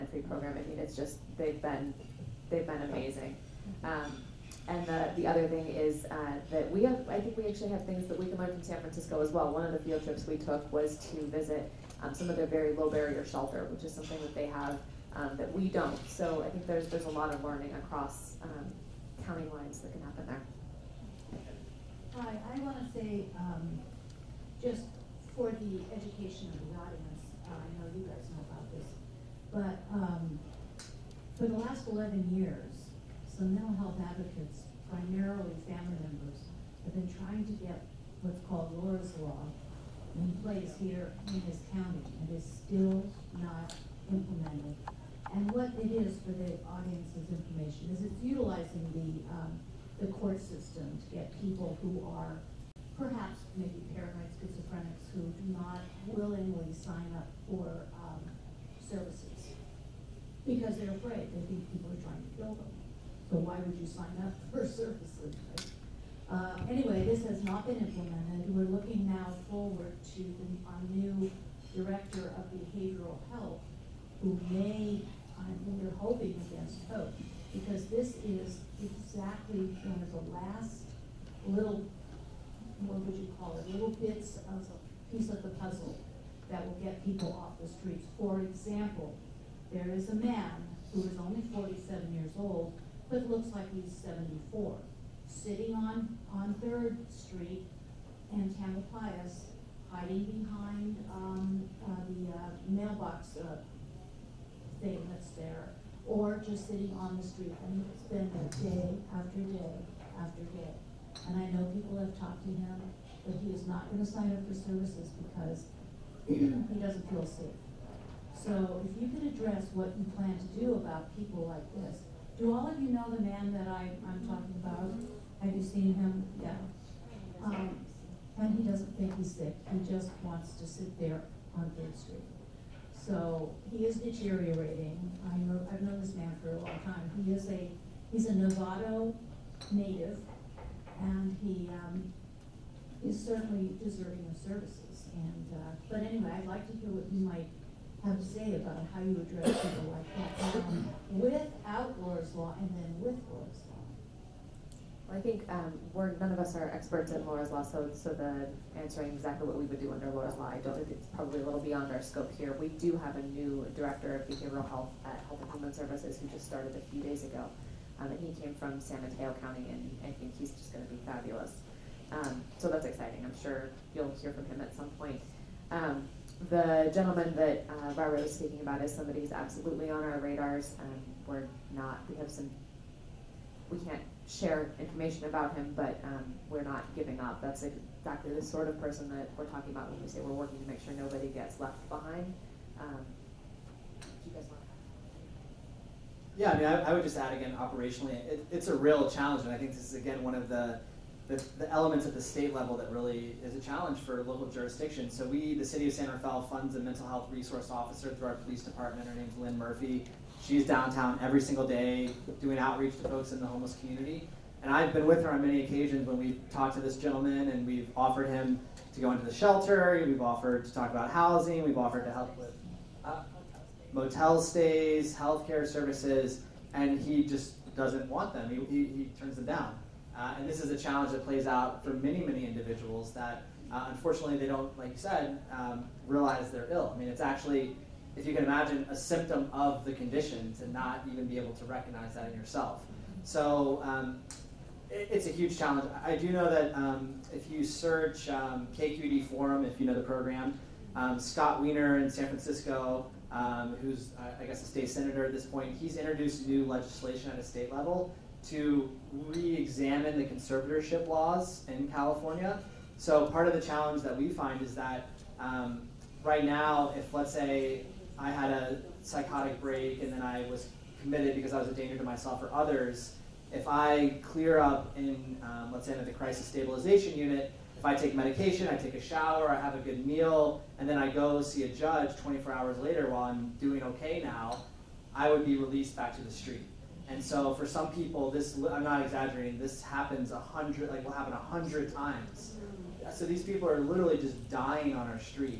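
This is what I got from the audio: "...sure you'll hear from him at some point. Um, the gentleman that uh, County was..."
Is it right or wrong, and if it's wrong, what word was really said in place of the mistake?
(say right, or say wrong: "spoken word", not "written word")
wrong: "Barbara", not "County".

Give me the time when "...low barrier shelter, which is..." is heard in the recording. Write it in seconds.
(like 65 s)
12 s.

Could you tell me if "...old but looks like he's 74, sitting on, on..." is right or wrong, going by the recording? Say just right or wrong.
right.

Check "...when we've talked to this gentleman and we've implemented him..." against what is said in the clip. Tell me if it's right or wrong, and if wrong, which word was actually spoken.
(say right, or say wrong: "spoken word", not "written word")
wrong: "offered", not "implemented".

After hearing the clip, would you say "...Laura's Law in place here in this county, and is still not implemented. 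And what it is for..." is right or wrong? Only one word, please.
right.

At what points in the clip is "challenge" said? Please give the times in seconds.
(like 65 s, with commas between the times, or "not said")
199 s, 203 s, 230 s, 245 s, 263 s.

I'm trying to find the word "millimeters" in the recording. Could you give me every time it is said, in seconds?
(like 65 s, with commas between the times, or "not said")
not said.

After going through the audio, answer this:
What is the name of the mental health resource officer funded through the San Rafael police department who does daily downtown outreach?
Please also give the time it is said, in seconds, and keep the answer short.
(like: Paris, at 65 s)
Lynn Murphy, at 209 s.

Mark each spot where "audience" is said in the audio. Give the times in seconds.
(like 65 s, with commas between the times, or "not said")
26 s, 46 s.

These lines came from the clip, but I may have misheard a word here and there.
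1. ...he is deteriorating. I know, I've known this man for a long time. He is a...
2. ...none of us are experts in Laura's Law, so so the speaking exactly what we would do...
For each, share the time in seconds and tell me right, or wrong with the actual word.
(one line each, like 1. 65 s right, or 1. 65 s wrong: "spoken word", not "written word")
1. 133 s right
2. 156 s wrong: "answering", not "speaking".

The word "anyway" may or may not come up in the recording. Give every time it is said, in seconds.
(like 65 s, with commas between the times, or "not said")
66 s, 146 s.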